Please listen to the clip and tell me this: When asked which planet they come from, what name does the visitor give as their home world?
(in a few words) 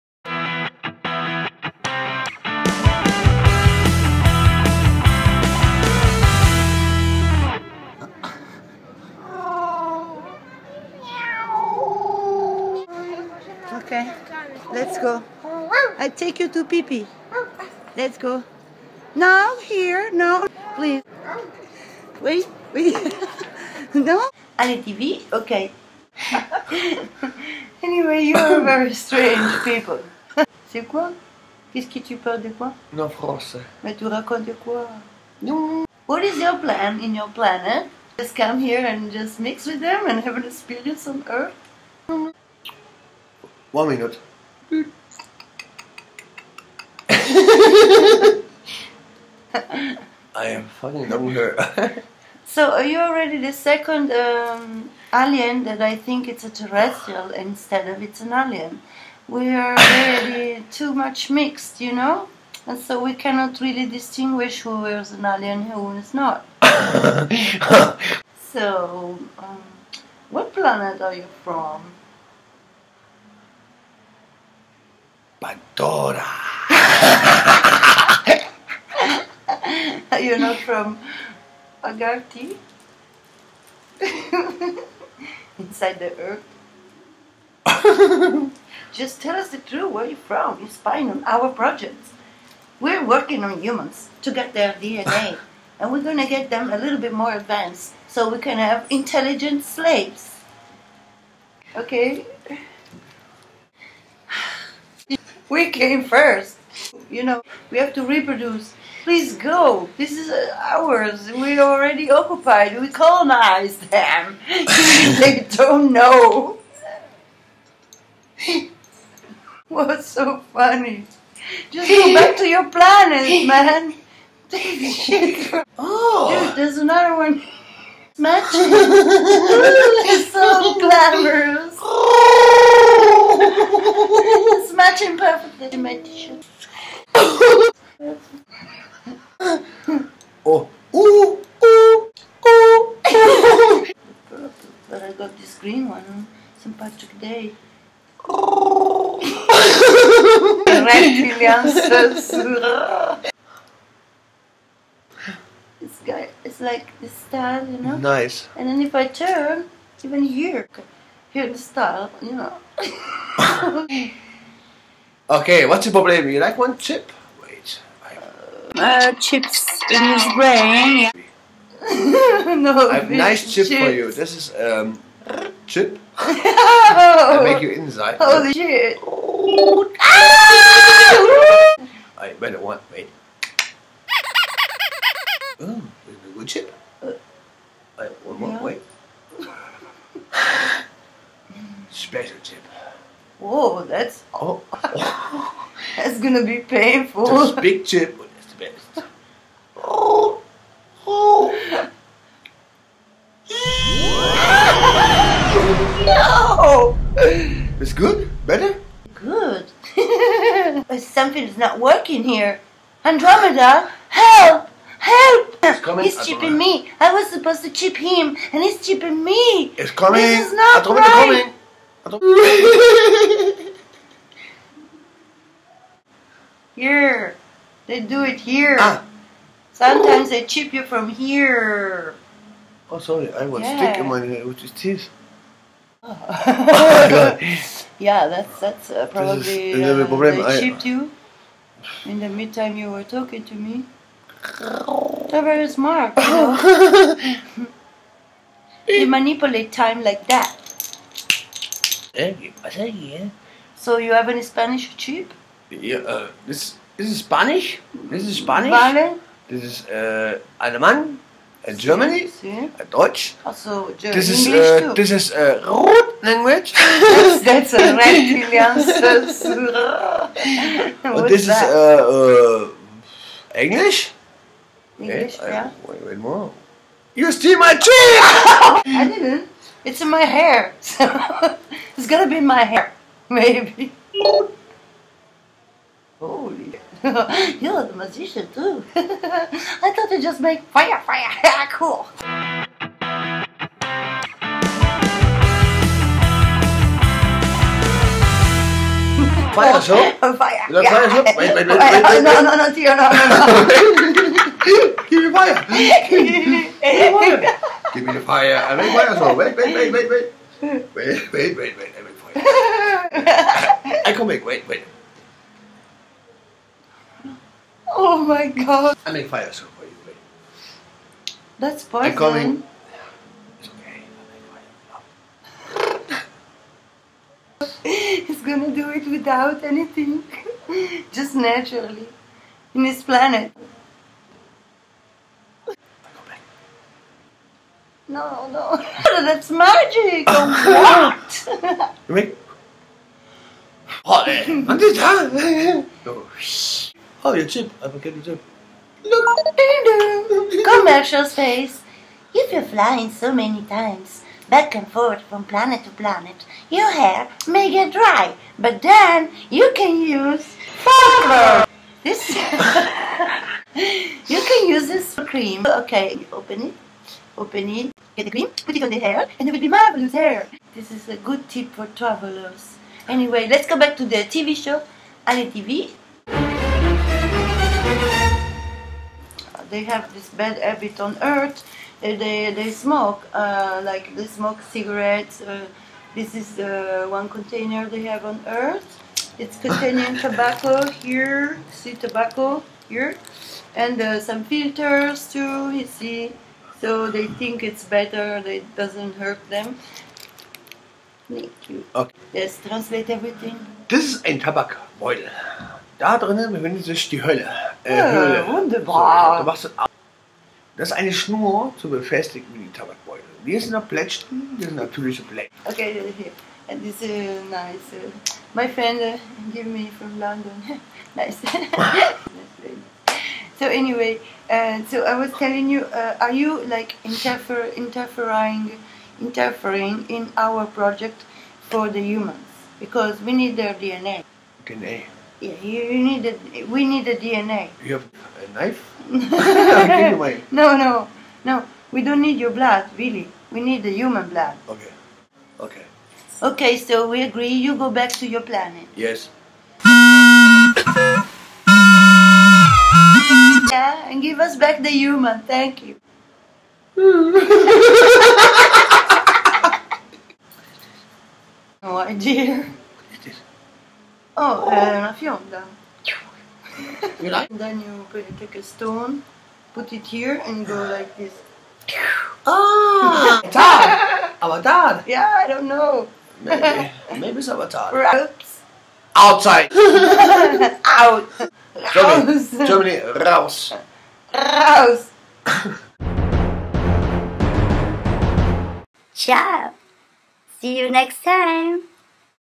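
Pandora.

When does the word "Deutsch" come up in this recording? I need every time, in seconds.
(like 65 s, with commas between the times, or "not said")
262 s.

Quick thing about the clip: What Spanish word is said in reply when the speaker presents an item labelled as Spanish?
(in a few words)
Vale.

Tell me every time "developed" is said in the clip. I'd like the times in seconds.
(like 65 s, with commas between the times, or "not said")
not said.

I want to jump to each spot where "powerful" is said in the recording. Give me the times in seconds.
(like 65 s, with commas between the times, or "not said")
not said.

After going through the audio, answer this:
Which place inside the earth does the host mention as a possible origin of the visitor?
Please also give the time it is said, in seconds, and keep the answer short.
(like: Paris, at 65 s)
Agarti, at 81 s.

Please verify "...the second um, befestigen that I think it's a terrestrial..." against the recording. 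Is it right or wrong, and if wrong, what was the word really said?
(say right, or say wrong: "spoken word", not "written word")
wrong: "alien", not "befestigen".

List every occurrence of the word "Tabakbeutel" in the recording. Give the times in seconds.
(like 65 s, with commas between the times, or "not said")
404 s, 412 s.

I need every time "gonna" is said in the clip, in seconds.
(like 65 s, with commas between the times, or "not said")
196 s, 282 s, 328 s.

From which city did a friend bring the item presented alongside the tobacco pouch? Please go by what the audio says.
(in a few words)
London.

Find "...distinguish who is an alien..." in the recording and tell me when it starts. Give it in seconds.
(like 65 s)
63 s.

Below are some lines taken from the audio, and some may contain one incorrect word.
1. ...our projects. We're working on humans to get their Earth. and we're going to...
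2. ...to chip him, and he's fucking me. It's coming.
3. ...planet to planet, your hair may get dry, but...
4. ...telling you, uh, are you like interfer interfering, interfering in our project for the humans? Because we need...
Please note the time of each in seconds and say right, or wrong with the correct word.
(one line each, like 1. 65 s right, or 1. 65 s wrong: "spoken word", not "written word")
1. 91 s wrong: "DNA", not "Earth"
2. 217 s wrong: "chipping", not "fucking"
3. 355 s right
4. 425 s right.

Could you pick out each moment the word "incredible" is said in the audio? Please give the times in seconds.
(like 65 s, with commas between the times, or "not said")
not said.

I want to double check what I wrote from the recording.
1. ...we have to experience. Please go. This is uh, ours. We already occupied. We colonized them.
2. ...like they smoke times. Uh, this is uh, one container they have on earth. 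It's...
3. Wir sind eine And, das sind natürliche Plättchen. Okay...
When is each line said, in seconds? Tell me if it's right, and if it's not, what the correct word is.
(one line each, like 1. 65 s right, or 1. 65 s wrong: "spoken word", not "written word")
1. 107 s wrong: "reproduce", not "experience"
2. 383 s wrong: "cigarettes", not "times"
3. 413 s wrong: "Plättchen", not "And".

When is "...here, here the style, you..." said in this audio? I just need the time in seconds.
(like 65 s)
160 s.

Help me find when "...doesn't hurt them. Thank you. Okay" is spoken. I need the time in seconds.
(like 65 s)
398 s.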